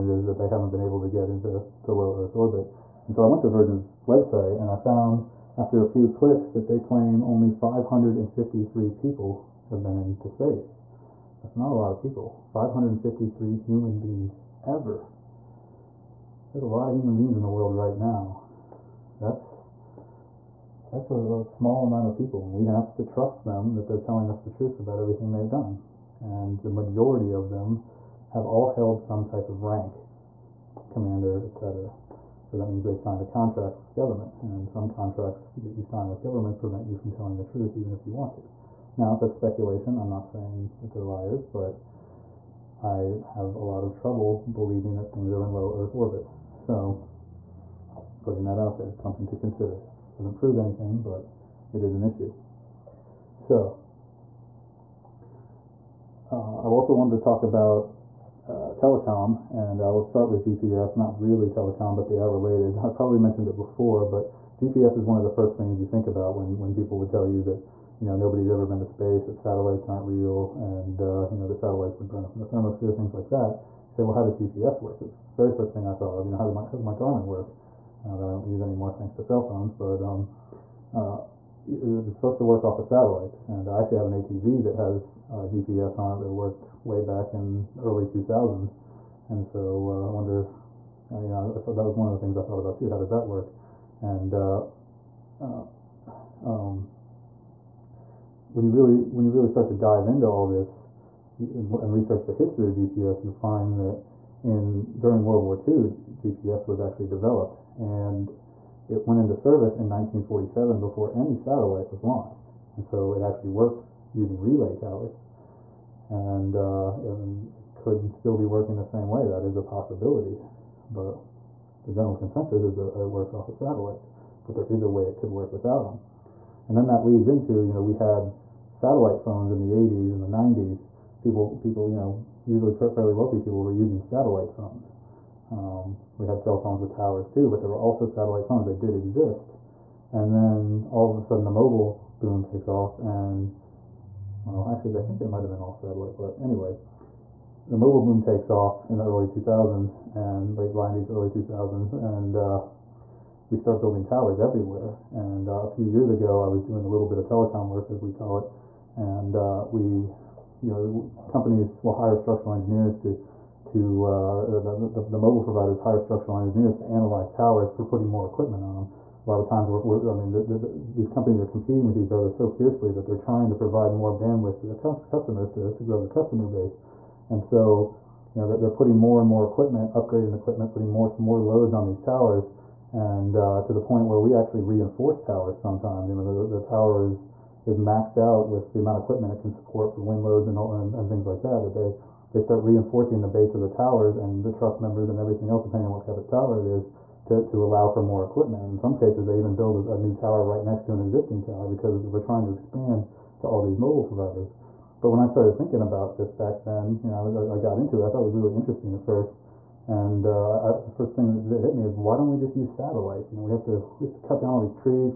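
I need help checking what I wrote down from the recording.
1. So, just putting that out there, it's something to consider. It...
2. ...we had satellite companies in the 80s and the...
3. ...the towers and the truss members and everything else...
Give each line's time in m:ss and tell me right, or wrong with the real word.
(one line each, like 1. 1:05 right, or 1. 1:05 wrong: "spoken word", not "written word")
1. 0:46 right
2. 2:07 wrong: "phones", not "companies"
3. 3:13 right.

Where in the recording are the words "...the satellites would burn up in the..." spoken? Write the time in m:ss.
1:11.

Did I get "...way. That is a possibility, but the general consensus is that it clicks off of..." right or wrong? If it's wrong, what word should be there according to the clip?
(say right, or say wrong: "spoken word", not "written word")
wrong: "works", not "clicks".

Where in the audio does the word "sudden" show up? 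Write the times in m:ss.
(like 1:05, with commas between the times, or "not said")
2:21.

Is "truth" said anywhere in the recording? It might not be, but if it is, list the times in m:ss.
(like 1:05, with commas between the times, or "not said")
0:24, 0:37.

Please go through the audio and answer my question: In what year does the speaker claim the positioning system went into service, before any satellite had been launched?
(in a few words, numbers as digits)
1947.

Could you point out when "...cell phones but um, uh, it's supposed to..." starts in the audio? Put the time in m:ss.
1:19.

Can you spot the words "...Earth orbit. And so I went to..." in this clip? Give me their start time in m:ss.
0:02.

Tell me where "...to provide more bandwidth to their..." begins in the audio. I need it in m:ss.
2:53.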